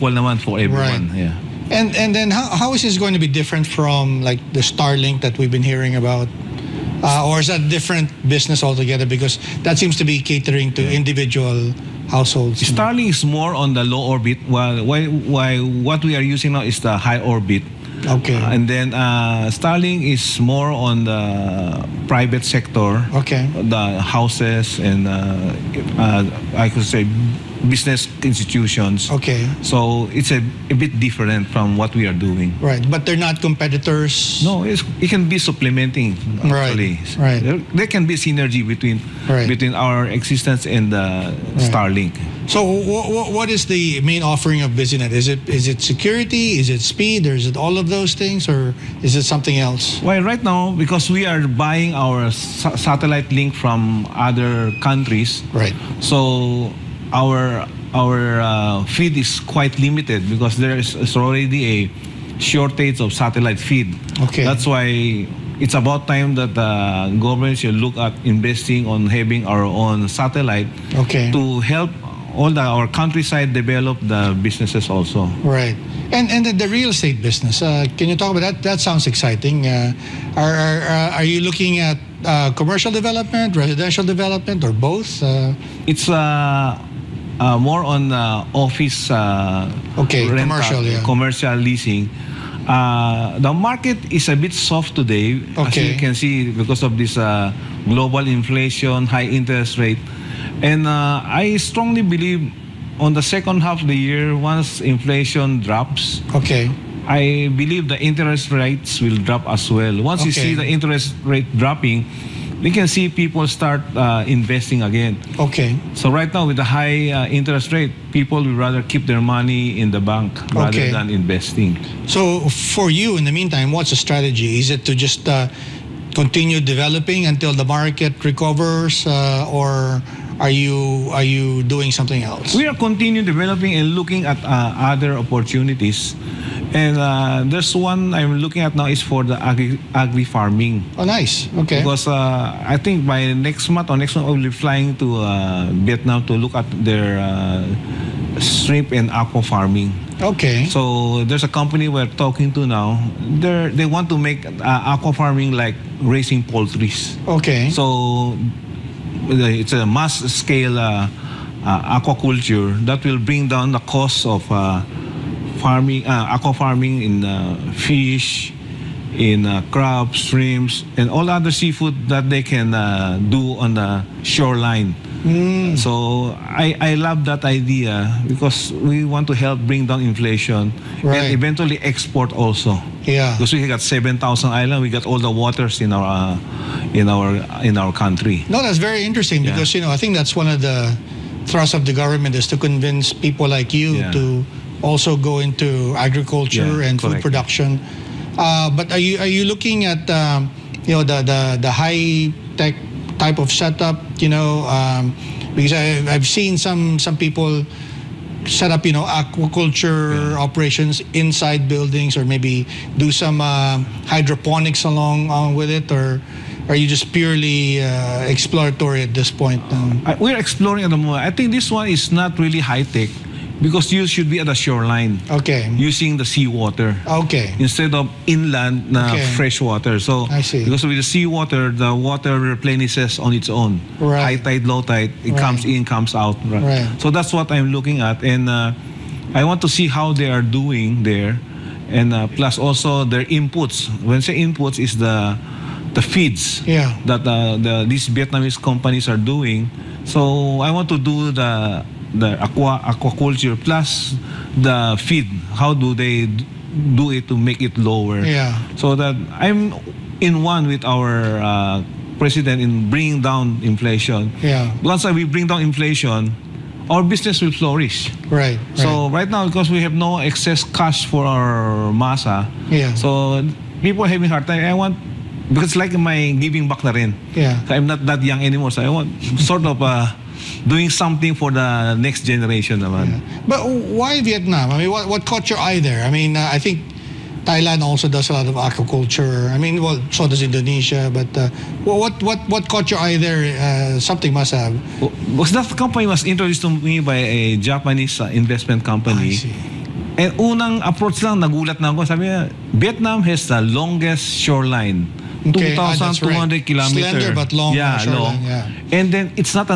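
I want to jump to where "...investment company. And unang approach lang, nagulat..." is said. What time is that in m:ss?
4:58.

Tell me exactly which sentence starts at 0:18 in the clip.
Uh, and then uh, Starlink is more on the private sector.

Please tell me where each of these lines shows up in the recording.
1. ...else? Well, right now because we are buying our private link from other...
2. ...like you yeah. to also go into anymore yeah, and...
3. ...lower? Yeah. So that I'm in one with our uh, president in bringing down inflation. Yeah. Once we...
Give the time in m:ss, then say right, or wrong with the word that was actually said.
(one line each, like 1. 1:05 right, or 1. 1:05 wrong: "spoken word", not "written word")
1. 0:49 wrong: "satellite", not "private"
2. 3:13 wrong: "agriculture", not "anymore"
3. 4:17 right.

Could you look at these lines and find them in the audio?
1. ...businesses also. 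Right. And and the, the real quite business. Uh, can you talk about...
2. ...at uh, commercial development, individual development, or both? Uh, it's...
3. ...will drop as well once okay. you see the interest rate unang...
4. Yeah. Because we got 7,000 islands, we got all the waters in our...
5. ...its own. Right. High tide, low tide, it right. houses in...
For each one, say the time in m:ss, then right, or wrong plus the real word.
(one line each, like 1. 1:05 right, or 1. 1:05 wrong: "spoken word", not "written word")
1. 1:14 wrong: "estate", not "quite"
2. 1:21 wrong: "residential", not "individual"
3. 1:49 wrong: "dropping", not "unang"
4. 3:03 right
5. 3:53 wrong: "comes", not "houses".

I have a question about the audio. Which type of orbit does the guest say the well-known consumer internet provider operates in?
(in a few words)
low orbit.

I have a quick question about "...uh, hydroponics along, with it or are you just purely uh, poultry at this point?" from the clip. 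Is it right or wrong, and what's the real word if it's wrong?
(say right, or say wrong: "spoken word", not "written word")
wrong: "exploratory", not "poultry".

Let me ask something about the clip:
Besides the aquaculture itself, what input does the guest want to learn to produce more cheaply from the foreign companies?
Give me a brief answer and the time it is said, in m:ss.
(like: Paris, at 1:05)
feeds, at 4:06.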